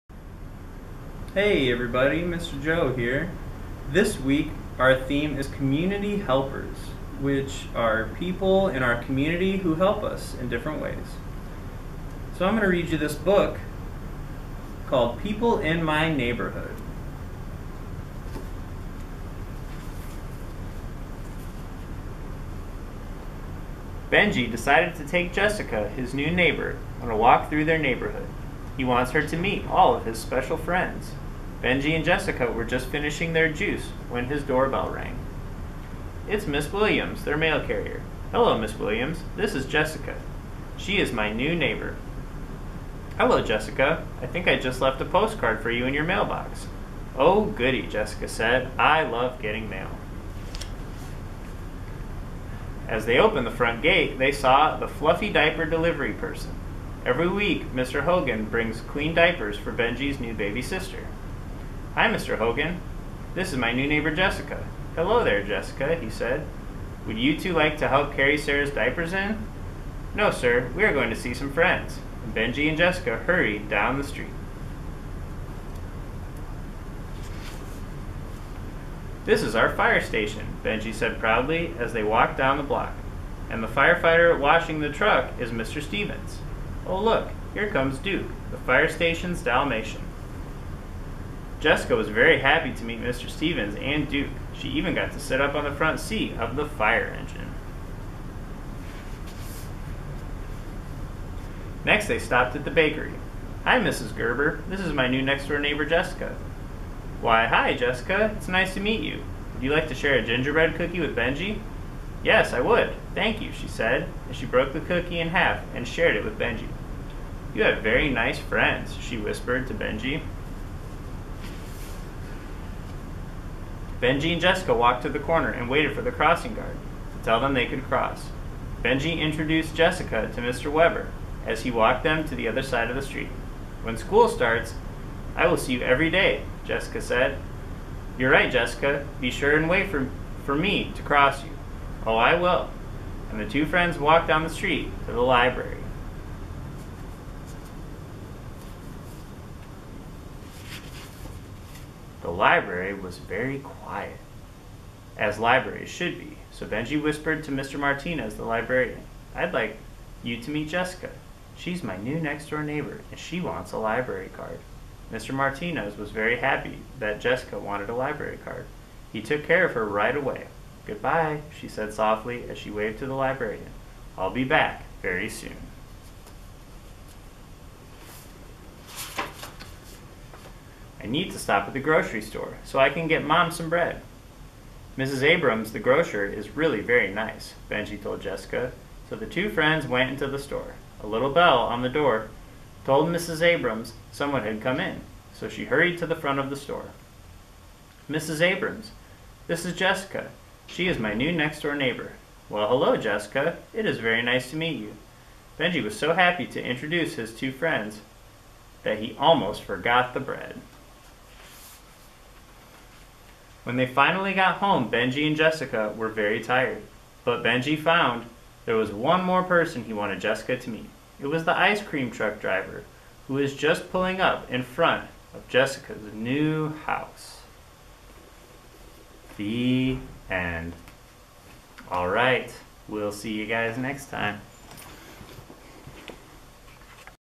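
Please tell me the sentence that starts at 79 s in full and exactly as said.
This is our fire station, Benji said proudly as they walked down the block.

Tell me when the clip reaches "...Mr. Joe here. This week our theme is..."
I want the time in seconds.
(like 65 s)
2 s.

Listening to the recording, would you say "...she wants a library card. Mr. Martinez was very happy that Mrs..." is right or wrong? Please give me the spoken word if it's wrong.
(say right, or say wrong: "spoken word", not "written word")
wrong: "Jessica", not "Mrs".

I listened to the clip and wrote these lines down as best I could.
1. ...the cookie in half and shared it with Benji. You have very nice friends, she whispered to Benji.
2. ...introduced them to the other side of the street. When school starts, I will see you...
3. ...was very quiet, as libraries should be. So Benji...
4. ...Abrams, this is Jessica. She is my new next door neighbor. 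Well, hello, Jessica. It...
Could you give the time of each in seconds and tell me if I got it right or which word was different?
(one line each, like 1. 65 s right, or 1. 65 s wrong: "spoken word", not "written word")
1. 114 s right
2. 131 s wrong: "walked", not "introduced"
3. 152 s right
4. 198 s right.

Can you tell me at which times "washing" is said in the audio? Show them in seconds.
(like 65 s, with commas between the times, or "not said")
84 s.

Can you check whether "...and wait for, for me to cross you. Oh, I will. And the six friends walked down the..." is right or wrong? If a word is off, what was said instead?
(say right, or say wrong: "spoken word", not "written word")
wrong: "two", not "six".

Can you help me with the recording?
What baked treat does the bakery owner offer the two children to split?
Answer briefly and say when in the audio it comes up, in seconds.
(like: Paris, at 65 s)
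gingerbread cookie, at 110 s.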